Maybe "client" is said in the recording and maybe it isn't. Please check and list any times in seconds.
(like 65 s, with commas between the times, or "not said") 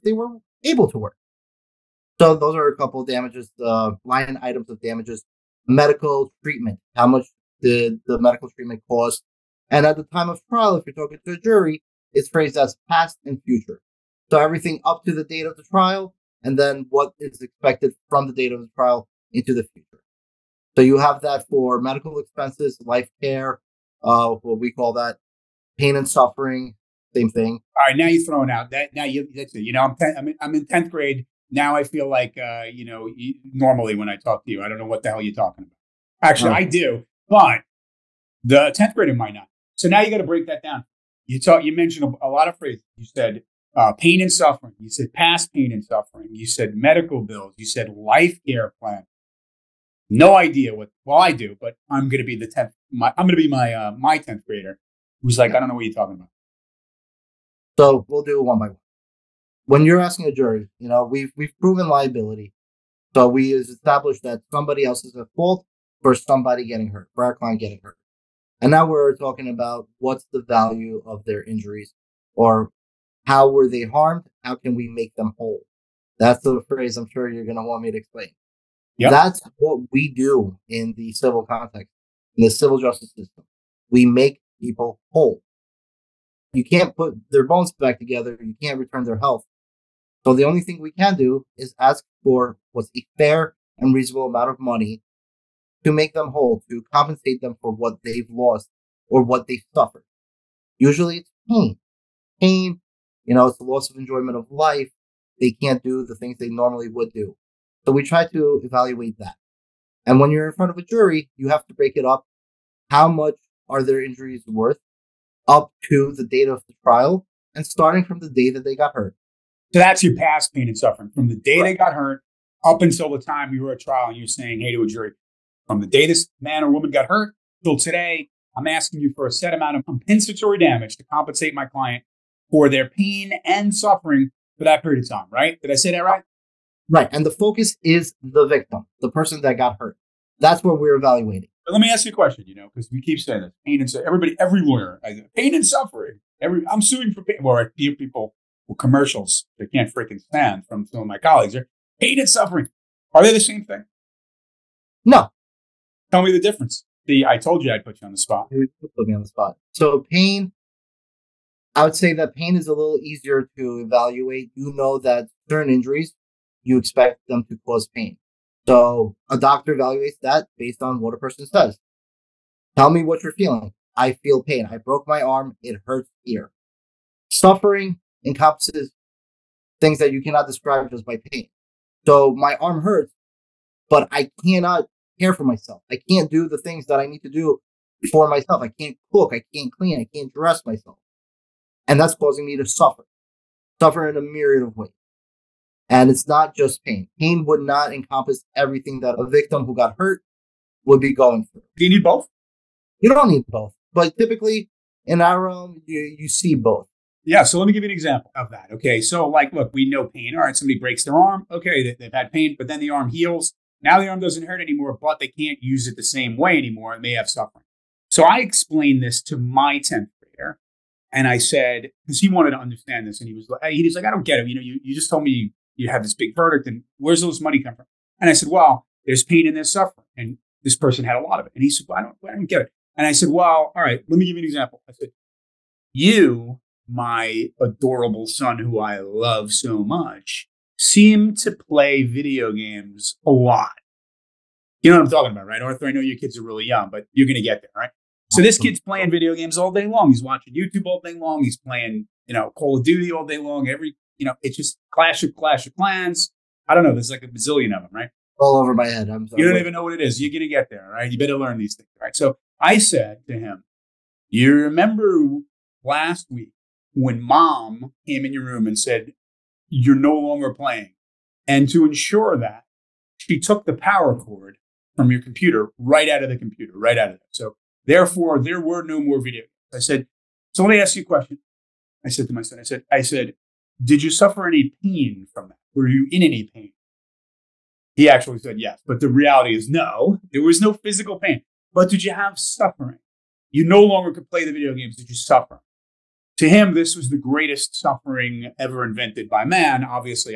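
67 s, 131 s.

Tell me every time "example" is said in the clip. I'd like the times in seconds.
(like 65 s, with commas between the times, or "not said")
207 s, 234 s.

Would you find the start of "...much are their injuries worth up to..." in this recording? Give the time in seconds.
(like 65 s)
113 s.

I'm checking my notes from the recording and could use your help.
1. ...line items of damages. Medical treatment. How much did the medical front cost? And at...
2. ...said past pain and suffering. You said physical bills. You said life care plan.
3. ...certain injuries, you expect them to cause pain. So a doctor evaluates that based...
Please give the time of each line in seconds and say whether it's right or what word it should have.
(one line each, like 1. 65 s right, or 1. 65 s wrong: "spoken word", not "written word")
1. 4 s wrong: "treatment", not "front"
2. 44 s wrong: "medical", not "physical"
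3. 165 s right.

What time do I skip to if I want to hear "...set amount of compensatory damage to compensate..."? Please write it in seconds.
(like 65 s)
129 s.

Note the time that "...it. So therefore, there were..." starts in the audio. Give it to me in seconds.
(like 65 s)
277 s.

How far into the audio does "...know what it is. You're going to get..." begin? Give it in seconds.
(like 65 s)
259 s.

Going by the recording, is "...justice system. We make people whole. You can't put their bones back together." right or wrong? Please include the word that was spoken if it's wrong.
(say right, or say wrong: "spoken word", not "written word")
right.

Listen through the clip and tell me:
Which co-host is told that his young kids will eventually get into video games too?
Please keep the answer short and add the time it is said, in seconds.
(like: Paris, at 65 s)
Arthur, at 245 s.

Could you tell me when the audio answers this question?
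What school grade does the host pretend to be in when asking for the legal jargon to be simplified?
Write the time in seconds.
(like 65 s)
30 s.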